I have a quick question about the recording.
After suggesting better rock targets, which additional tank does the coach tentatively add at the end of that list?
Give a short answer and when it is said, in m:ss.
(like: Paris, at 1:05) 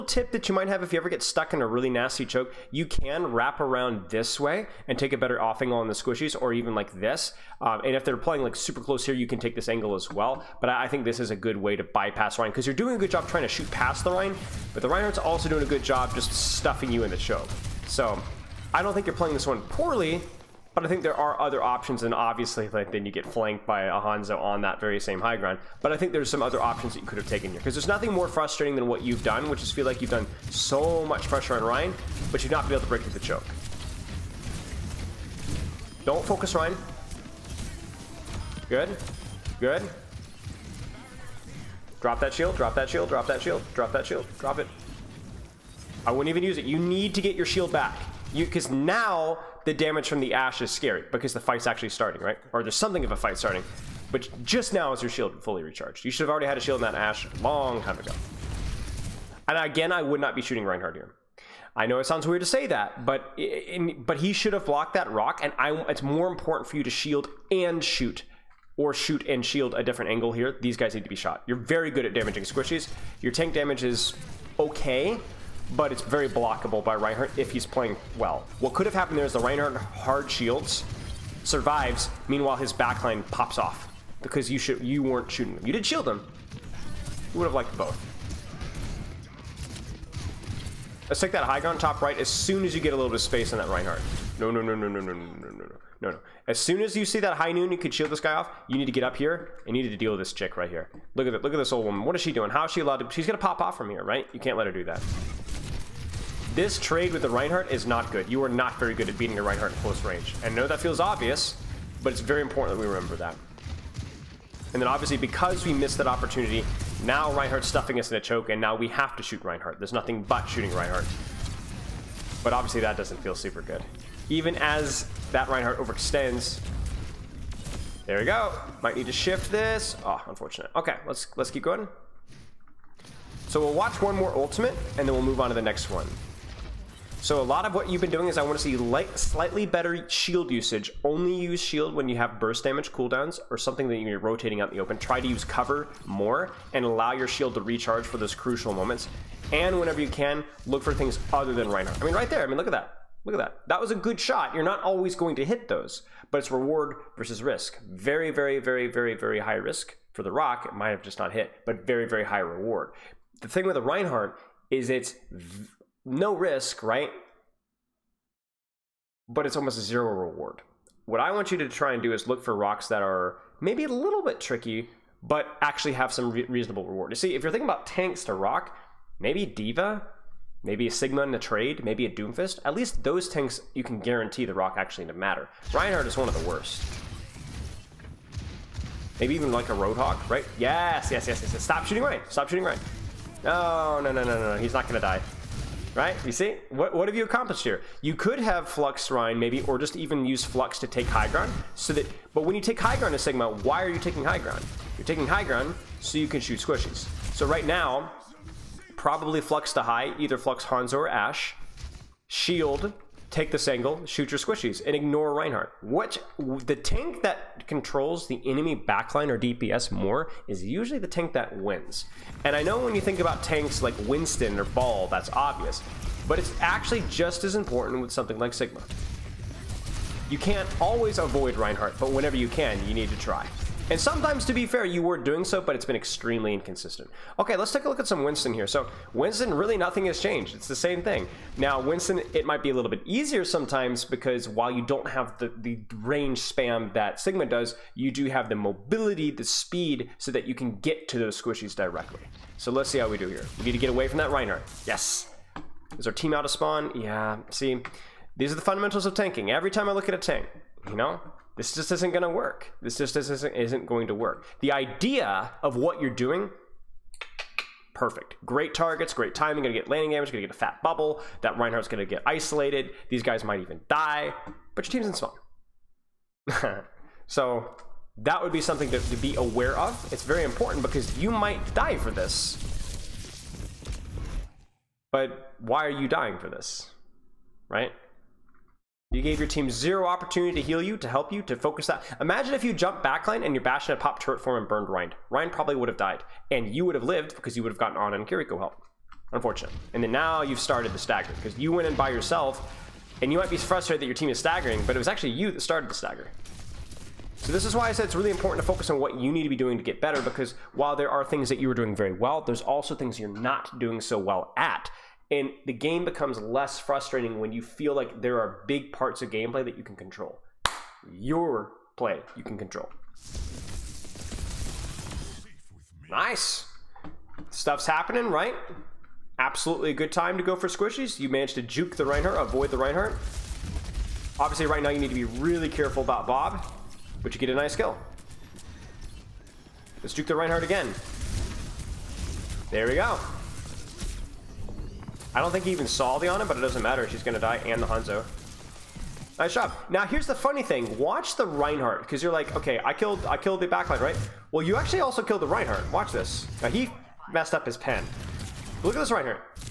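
Roadhog, at 3:09.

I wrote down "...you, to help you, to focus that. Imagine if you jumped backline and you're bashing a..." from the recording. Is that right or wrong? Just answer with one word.
right.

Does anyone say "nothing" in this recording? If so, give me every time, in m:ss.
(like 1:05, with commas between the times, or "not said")
0:27, 1:59, 3:59.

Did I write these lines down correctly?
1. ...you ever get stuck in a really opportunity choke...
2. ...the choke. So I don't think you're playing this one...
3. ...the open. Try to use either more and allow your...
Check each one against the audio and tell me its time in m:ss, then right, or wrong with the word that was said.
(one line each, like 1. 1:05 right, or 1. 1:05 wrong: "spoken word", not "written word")
1. 0:00 wrong: "nasty", not "opportunity"
2. 0:17 right
3. 2:24 wrong: "cover", not "either".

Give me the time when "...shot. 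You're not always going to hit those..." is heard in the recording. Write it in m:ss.
2:34.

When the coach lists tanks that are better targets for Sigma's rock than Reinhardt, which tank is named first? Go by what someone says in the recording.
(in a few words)
D.Va.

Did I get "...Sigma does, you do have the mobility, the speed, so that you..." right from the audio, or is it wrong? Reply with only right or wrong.
right.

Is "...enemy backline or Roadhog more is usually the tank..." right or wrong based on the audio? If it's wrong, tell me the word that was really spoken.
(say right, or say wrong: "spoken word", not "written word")
wrong: "DPS", not "Roadhog".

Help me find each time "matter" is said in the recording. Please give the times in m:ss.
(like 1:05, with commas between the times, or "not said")
3:05, 5:46.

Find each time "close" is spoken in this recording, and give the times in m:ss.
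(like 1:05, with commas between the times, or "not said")
0:08, 1:49.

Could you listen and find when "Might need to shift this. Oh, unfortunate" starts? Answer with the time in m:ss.
2:08.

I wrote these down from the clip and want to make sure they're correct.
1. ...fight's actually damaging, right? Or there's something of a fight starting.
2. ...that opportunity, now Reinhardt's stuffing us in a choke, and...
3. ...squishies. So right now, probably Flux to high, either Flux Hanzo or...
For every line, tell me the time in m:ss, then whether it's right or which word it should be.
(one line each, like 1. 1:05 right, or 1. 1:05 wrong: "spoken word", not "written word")
1. 0:51 wrong: "starting", not "damaging"
2. 1:55 right
3. 3:26 right.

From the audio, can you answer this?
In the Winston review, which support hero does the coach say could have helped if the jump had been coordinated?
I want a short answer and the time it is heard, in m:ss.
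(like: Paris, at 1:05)
Kiriko, at 4:58.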